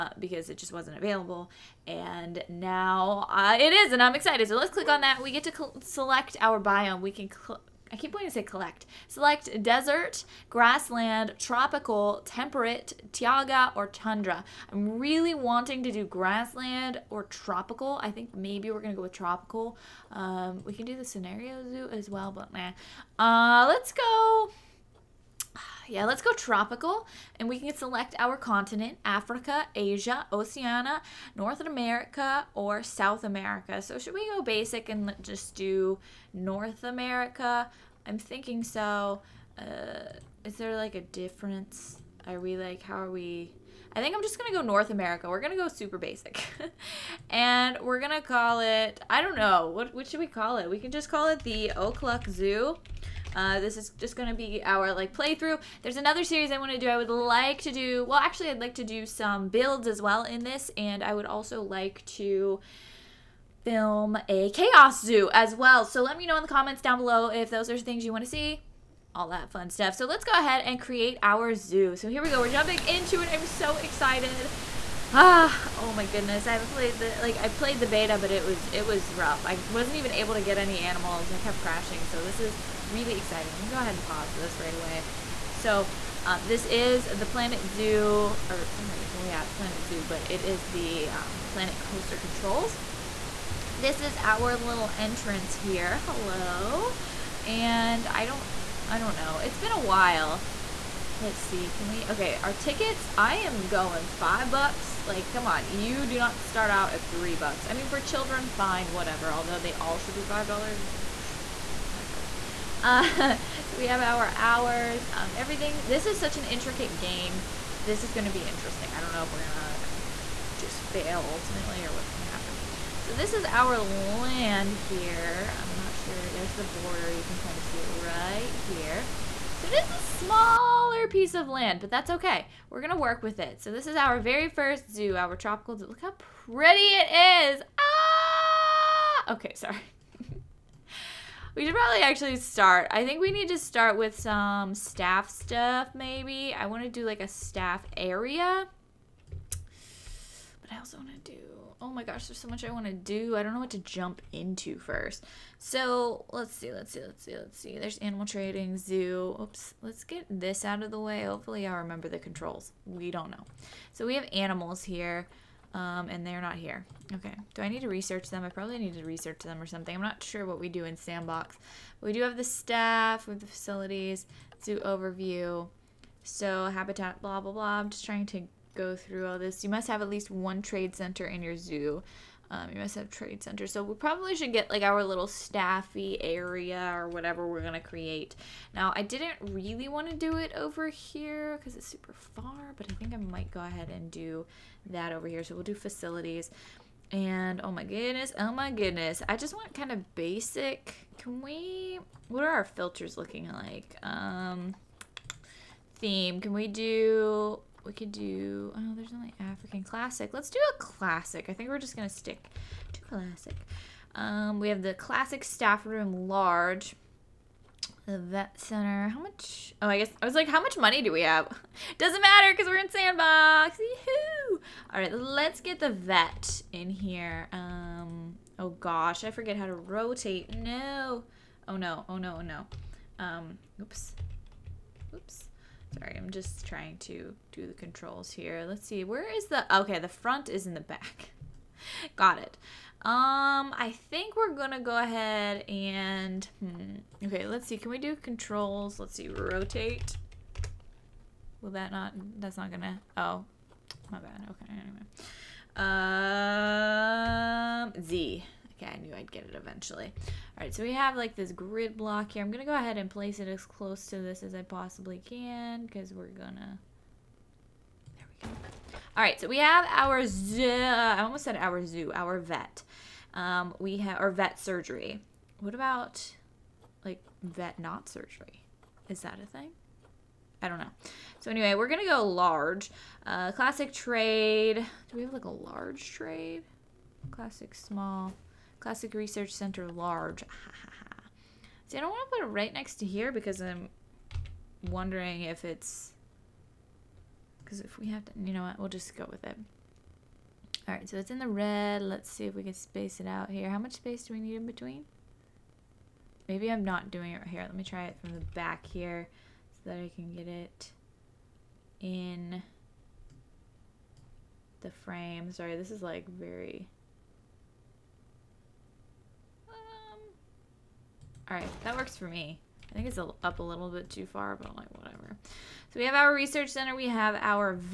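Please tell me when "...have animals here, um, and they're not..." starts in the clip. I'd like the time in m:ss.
2:44.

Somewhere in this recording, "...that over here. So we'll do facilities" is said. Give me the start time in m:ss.
3:14.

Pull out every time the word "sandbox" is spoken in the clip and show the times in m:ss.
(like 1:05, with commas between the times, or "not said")
2:50, 3:42.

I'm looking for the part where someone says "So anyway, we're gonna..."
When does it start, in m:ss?
4:41.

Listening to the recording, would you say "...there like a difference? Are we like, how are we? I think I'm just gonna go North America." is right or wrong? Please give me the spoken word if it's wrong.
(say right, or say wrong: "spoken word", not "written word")
right.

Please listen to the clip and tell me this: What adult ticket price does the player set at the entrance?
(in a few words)
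$5.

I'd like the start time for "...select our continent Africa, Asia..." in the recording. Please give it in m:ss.
0:27.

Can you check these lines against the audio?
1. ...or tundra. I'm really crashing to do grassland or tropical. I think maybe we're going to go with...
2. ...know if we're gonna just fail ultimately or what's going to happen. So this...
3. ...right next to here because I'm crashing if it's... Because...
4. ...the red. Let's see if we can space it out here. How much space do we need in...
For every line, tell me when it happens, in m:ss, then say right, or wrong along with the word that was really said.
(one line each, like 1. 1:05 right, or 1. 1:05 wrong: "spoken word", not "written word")
1. 0:13 wrong: "wanting", not "crashing"
2. 1:59 right
3. 4:52 wrong: "wondering", not "crashing"
4. 5:01 right.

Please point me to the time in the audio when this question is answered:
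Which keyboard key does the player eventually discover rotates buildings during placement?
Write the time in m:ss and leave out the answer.
4:18.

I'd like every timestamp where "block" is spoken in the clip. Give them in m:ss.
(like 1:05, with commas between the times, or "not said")
4:21.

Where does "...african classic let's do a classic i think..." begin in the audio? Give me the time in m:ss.
3:29.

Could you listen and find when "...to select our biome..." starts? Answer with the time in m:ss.
0:05.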